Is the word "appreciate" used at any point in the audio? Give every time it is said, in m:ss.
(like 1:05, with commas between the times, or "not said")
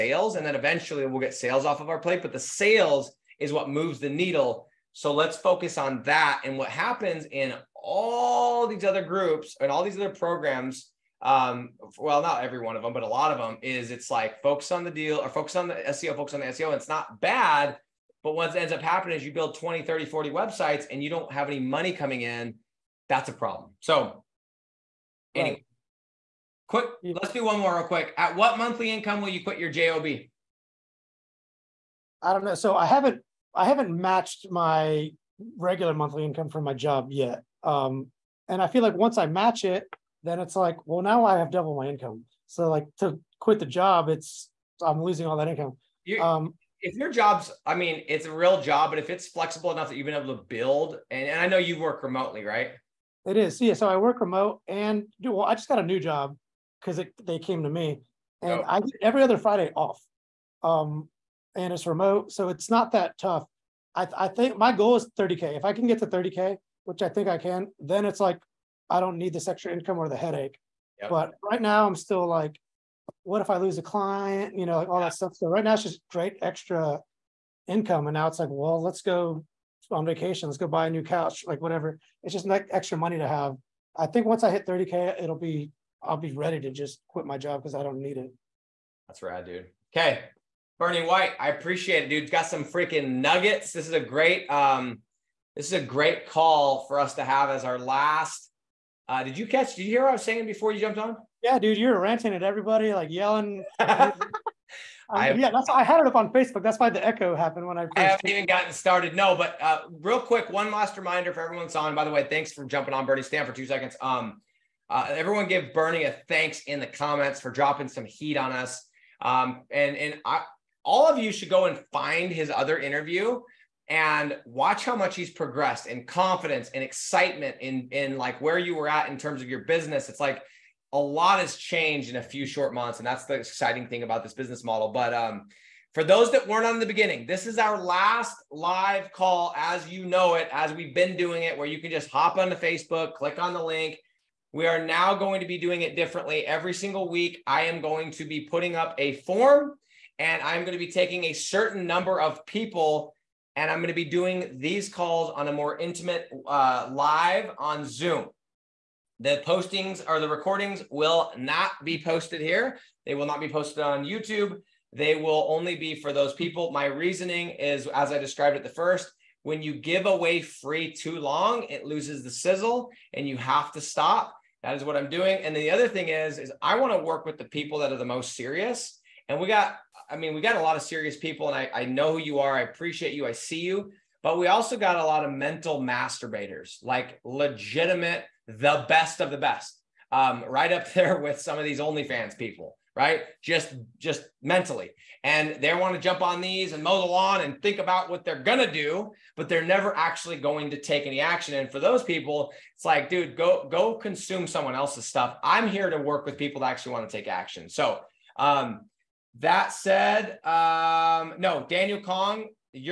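1:31, 3:02.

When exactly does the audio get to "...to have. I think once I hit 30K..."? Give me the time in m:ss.
1:23.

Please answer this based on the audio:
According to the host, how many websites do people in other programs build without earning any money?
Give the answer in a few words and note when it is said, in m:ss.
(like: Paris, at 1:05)
20, 30, 40, at 0:19.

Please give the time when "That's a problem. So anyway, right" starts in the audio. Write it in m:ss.
0:23.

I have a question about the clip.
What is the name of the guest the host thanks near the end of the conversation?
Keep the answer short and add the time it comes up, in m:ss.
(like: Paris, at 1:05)
Bernie White, at 1:30.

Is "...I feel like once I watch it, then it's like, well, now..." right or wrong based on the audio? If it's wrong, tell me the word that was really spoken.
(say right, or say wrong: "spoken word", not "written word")
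wrong: "match", not "watch".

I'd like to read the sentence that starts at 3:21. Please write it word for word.
And for those people, it's like, dude, go, go consume someone else's stuff.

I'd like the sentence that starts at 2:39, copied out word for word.
The postings or the recordings will not be posted here.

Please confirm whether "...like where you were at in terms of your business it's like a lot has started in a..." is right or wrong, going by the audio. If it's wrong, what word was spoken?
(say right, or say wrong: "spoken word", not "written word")
wrong: "changed", not "started".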